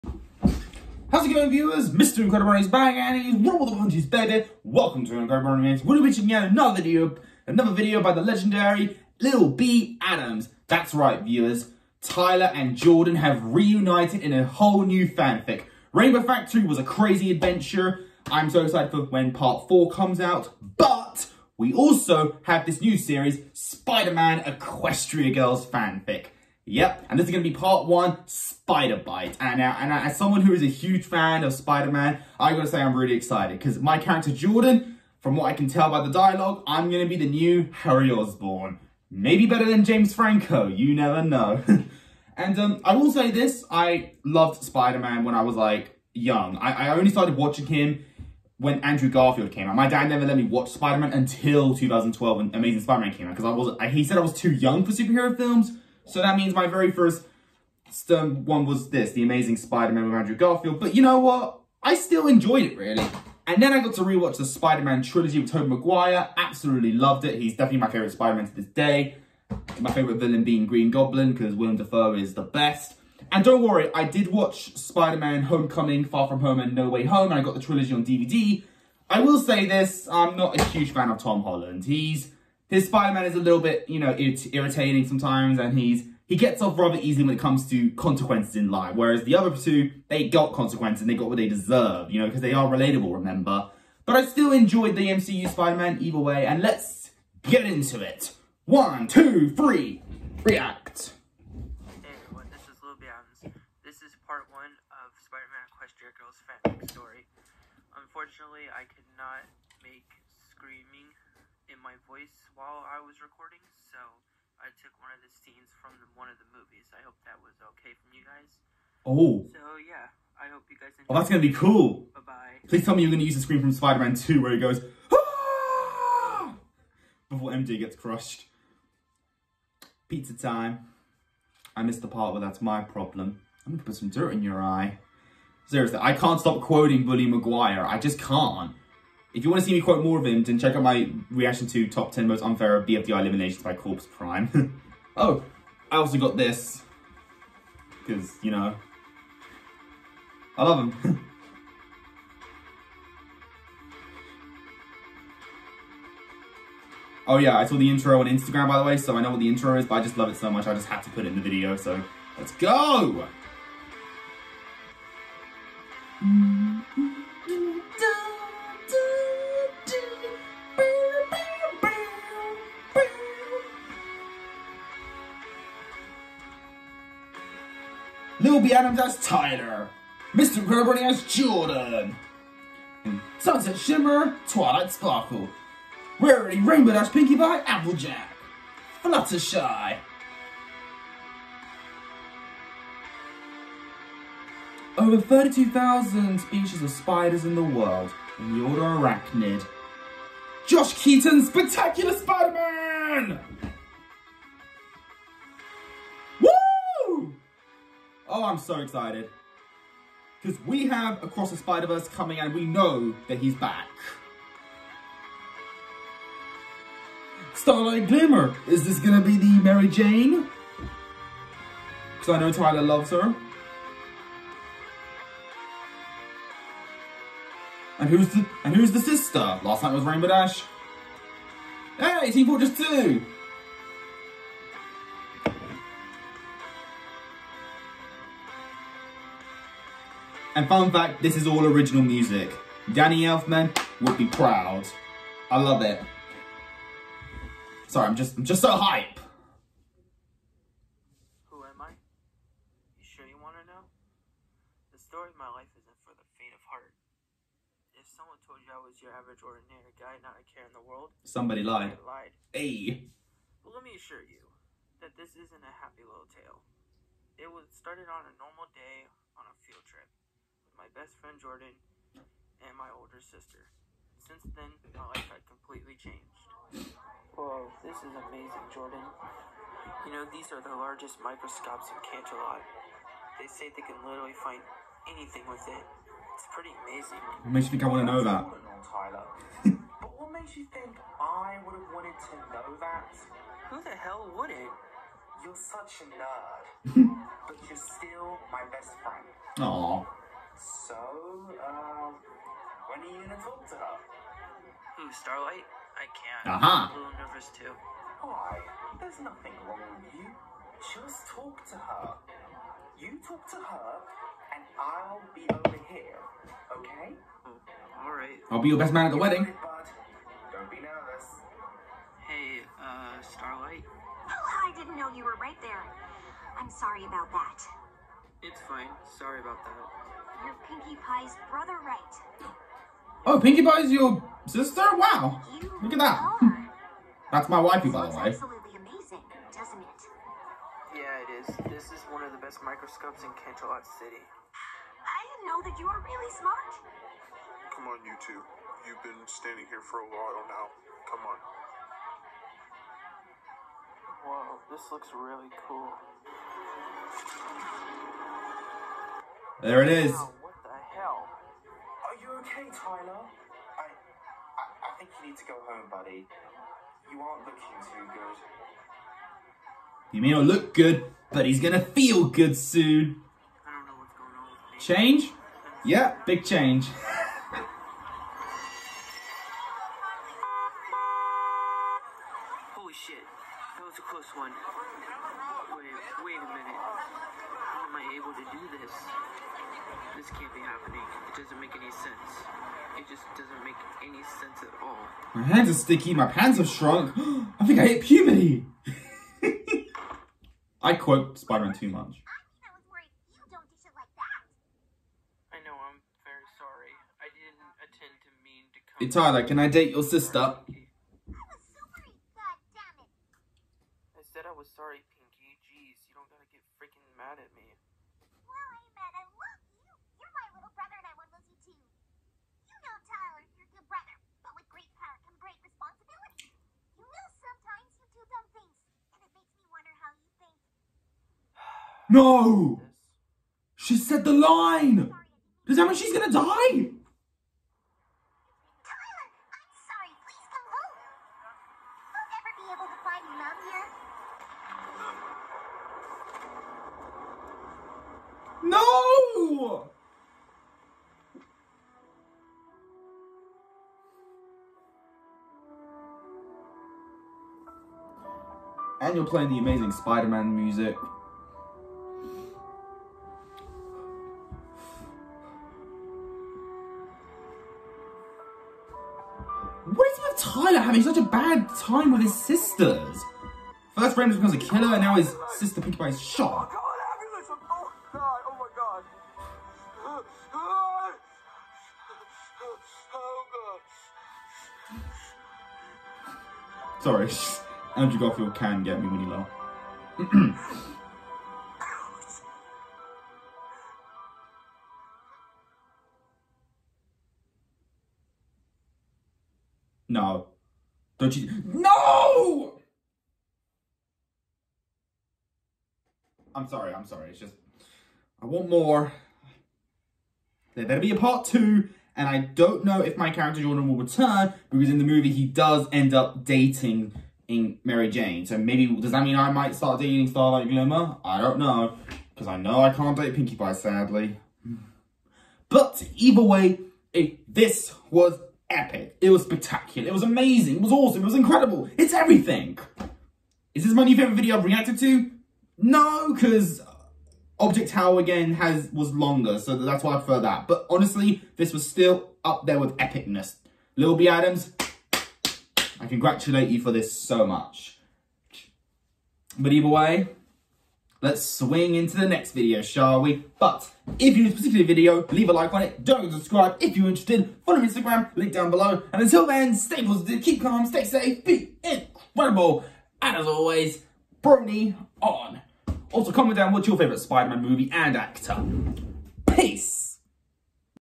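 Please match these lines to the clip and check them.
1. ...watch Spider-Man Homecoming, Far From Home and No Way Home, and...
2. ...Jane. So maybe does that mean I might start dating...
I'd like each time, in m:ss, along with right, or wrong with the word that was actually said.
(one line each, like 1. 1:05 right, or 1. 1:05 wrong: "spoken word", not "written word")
1. 1:14 right
2. 8:38 right.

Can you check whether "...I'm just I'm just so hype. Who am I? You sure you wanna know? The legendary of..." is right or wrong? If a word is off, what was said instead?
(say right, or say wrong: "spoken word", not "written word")
wrong: "story", not "legendary".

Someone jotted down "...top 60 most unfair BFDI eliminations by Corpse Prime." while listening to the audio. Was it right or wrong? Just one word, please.
wrong.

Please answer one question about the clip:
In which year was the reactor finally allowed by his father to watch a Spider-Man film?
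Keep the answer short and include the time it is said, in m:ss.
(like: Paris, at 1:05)
2012, at 0:51.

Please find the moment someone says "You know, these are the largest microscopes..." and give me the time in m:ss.
4:40.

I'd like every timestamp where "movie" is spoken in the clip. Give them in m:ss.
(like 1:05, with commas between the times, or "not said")
1:56, 8:35, 9:27.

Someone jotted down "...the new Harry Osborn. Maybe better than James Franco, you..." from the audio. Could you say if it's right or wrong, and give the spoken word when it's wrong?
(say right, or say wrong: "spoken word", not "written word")
right.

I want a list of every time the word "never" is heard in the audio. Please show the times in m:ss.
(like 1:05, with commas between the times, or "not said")
0:40, 0:50.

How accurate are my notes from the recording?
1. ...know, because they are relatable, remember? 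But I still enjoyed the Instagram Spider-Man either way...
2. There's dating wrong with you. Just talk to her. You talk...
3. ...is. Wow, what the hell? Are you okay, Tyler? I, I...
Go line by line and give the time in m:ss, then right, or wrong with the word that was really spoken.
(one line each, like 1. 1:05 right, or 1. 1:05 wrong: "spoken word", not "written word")
1. 1:32 wrong: "MCU", not "Instagram"
2. 5:08 wrong: "nothing", not "dating"
3. 5:59 right.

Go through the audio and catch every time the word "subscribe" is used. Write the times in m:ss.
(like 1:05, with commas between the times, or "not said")
9:16.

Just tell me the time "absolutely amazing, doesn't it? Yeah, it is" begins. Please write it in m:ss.
5:38.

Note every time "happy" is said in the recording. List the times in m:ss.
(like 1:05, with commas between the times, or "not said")
4:25.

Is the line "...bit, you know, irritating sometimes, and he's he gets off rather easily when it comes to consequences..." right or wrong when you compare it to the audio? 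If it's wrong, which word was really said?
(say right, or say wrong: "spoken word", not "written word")
right.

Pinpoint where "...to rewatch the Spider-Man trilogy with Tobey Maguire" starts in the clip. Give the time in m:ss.
1:03.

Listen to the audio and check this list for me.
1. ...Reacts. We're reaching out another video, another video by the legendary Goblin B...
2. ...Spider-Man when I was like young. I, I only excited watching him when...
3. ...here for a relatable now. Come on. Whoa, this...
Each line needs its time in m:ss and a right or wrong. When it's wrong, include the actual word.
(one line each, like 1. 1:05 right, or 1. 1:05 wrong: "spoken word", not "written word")
1. 0:05 wrong: "Lil", not "Goblin"
2. 0:44 wrong: "started", not "excited"
3. 5:49 wrong: "while", not "relatable".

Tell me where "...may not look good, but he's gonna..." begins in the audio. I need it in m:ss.
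6:10.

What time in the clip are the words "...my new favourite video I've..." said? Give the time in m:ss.
8:53.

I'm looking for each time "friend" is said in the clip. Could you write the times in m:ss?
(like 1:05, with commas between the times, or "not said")
4:31, 4:59.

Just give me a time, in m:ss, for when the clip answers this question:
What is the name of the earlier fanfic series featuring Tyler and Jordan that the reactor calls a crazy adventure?
0:15.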